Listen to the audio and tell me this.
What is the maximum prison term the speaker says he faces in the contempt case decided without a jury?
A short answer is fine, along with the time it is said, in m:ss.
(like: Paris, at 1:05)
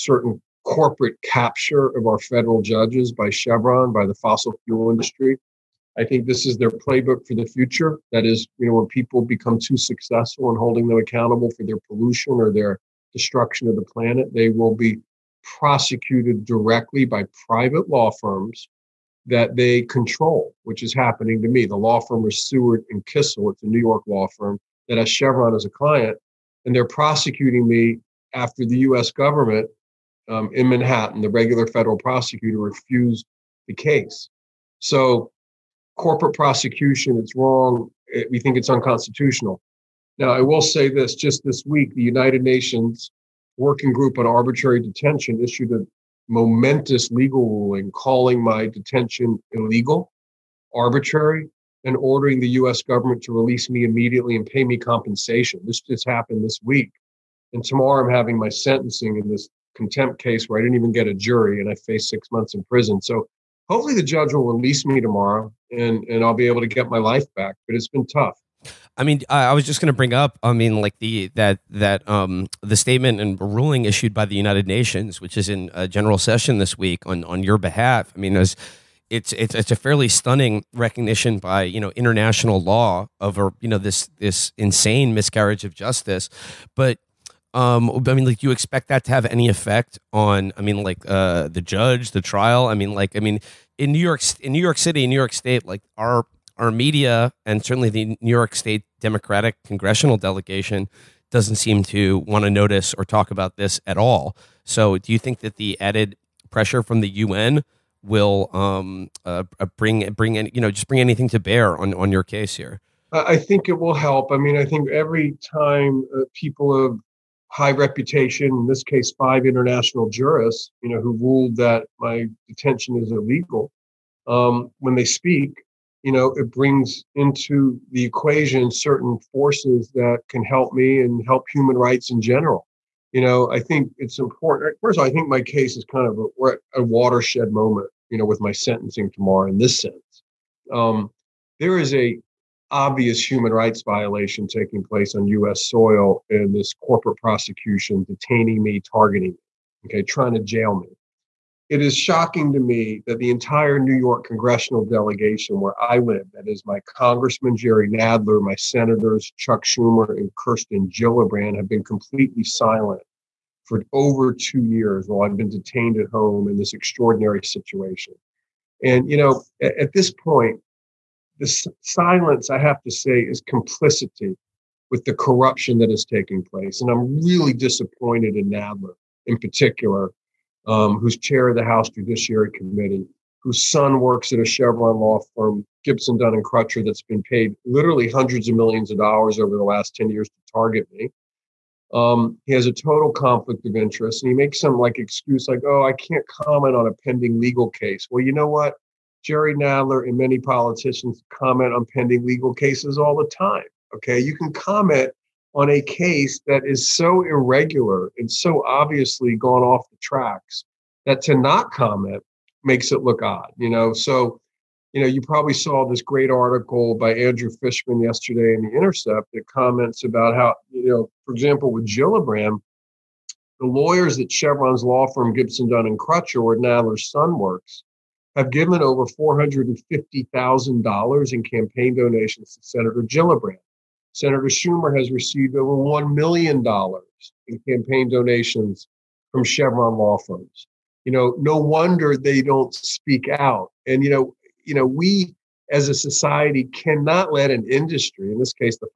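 6 months, at 1:02.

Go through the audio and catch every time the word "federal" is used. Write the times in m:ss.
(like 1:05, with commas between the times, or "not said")
0:02, 0:31.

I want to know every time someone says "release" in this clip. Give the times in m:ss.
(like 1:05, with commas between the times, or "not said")
0:53, 1:04.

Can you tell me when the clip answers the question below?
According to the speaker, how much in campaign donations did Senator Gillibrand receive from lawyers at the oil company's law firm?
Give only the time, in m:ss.
3:48.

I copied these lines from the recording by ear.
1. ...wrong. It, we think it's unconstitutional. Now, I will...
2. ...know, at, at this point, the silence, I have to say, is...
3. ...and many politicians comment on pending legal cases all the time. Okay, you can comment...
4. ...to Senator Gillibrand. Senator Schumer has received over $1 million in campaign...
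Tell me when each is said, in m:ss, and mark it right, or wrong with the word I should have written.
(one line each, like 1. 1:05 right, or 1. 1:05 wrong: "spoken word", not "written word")
1. 0:37 right
2. 2:49 right
3. 3:20 right
4. 3:52 right.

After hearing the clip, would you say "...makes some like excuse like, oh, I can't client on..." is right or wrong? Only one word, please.
wrong.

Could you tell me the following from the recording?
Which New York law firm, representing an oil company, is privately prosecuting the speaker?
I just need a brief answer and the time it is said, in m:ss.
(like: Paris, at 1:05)
Seward and Kissel, at 0:22.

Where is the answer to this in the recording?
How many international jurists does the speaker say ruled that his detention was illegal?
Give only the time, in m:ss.
1:59.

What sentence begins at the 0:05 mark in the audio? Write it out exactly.
I think this is their playbook for the future.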